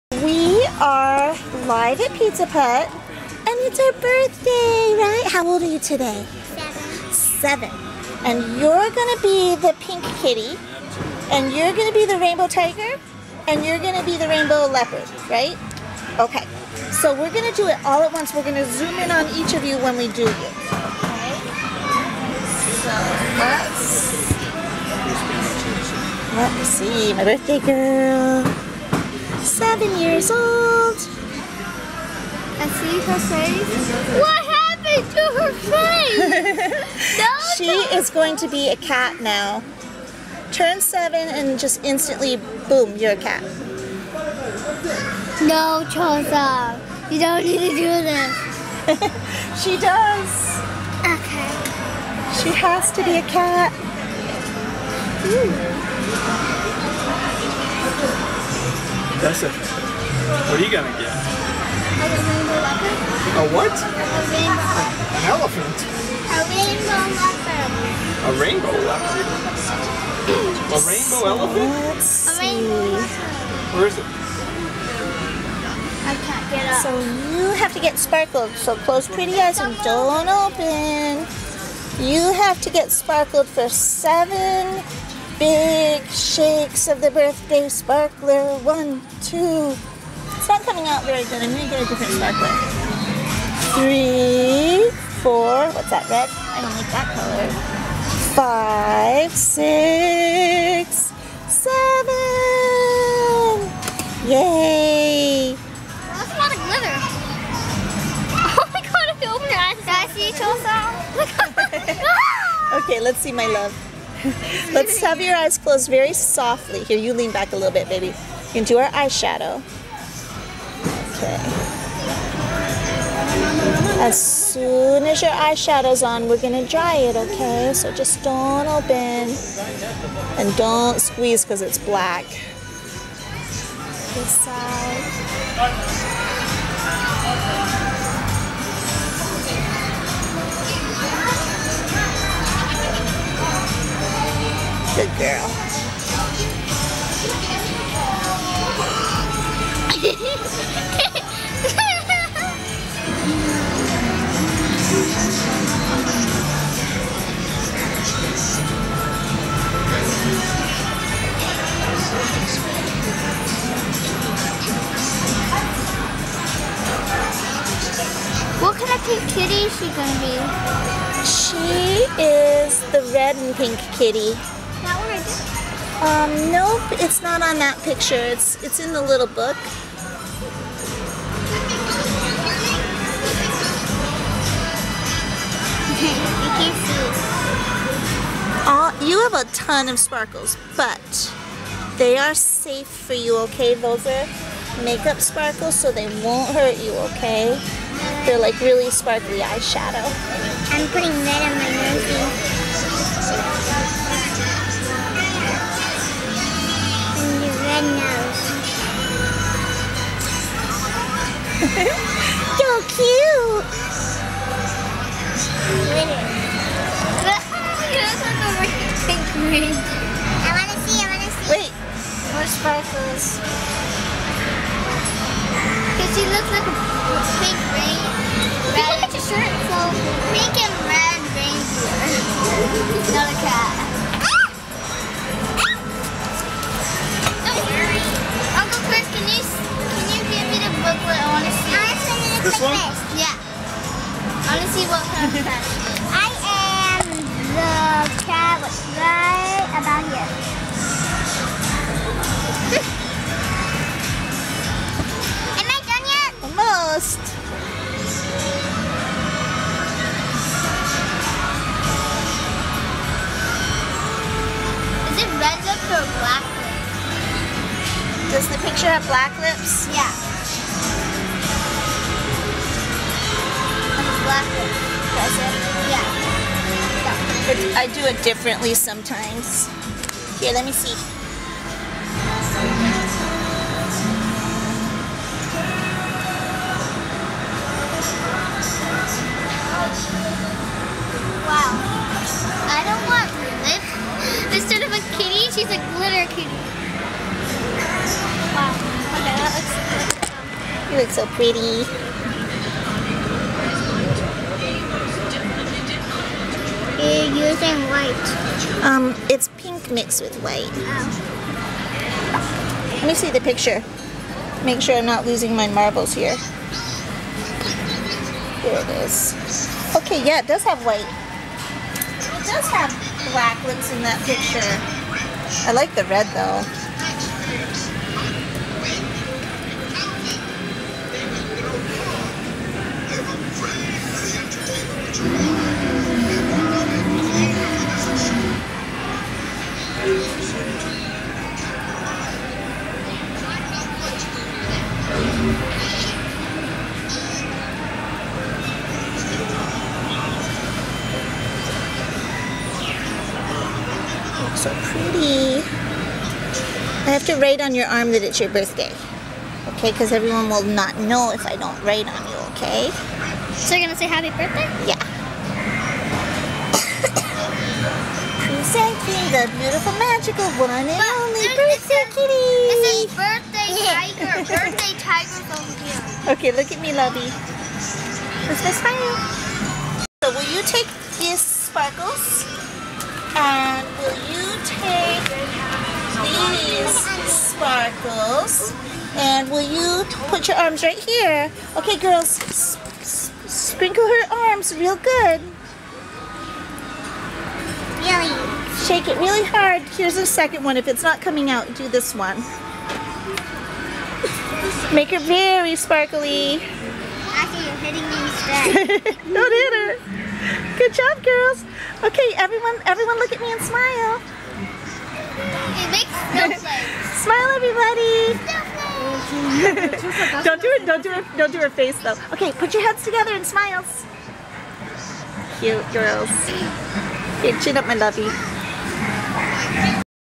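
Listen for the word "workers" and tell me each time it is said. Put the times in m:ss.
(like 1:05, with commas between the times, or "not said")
not said.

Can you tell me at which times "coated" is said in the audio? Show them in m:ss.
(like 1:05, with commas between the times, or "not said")
not said.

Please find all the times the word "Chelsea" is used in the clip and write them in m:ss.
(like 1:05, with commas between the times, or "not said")
1:50.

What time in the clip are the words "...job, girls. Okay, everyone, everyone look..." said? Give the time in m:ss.
6:50.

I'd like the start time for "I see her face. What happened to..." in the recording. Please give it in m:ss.
0:32.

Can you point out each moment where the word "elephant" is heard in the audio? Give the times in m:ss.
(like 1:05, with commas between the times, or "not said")
1:05, 1:11.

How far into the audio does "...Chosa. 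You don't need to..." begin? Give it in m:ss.
0:45.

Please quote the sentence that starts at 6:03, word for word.
So you're going to say happy birthday?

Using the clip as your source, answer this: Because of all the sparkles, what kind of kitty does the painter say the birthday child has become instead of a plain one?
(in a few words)
Glitter kitty.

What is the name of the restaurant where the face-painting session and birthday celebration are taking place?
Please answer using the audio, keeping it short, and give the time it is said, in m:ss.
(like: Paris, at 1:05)
Pizza Put, at 0:02.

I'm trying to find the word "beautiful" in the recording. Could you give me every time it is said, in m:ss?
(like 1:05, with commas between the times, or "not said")
6:09.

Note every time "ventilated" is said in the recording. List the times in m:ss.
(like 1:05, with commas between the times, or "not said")
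not said.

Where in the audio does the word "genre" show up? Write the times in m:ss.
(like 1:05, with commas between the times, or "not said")
not said.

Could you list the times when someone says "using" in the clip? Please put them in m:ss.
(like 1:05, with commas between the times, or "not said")
5:07.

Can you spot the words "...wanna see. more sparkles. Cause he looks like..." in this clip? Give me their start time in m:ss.
3:41.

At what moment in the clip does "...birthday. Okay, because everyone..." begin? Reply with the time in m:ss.
5:58.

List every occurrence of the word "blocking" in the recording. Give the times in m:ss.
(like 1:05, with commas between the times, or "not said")
not said.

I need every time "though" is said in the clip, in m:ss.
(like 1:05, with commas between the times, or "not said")
5:26, 7:02.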